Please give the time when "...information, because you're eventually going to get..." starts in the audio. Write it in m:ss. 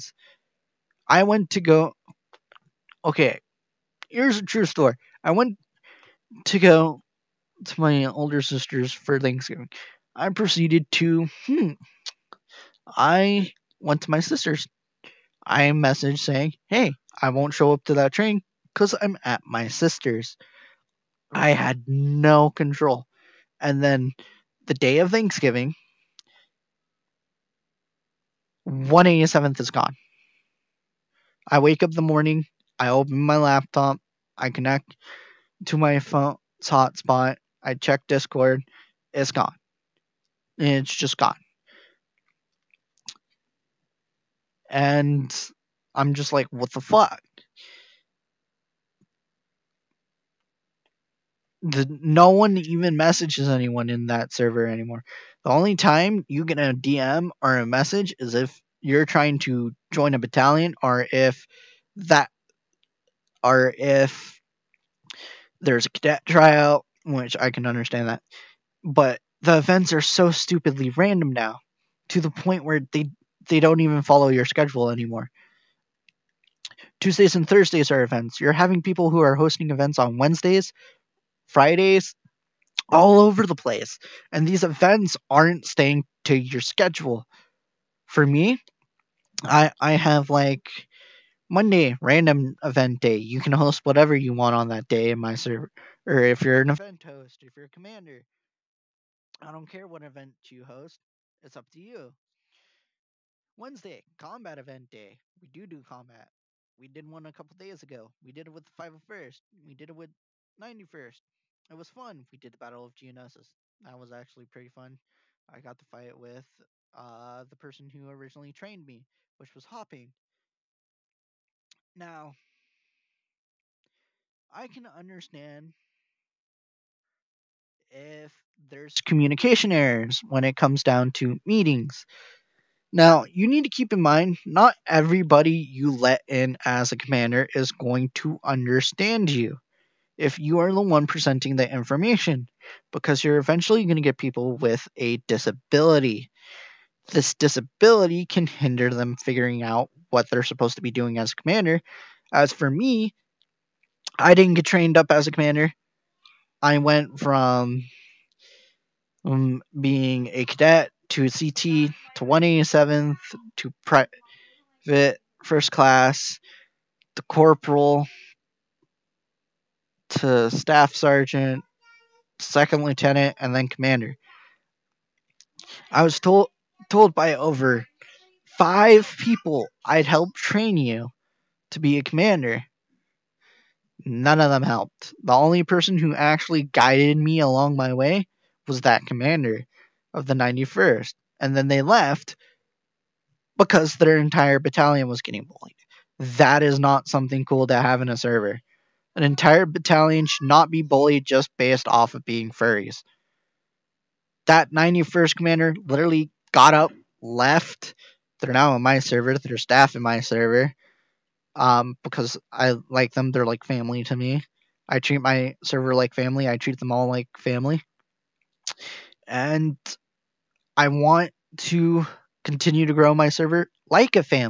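2:21.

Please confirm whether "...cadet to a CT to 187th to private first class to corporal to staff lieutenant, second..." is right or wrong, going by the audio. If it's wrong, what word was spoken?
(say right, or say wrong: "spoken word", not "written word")
wrong: "sergeant", not "lieutenant".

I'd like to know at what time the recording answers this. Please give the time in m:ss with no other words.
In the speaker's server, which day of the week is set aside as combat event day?
1:43.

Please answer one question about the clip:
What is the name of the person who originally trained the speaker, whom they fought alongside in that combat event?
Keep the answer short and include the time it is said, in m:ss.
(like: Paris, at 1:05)
Hopping, at 1:59.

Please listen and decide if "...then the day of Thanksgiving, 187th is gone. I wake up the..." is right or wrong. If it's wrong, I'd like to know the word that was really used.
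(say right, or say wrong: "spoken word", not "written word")
right.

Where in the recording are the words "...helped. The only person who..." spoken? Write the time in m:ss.
3:04.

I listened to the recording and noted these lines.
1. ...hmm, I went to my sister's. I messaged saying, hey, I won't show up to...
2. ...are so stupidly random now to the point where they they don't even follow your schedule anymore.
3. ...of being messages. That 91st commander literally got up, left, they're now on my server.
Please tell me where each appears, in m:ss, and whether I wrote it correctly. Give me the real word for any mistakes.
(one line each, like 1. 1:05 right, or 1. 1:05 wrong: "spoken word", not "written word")
1. 0:11 right
2. 1:09 right
3. 3:22 wrong: "furries", not "messages".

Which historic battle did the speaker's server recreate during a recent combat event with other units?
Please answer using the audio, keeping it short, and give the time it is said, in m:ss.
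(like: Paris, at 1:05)
Battle of Geonosis, at 1:52.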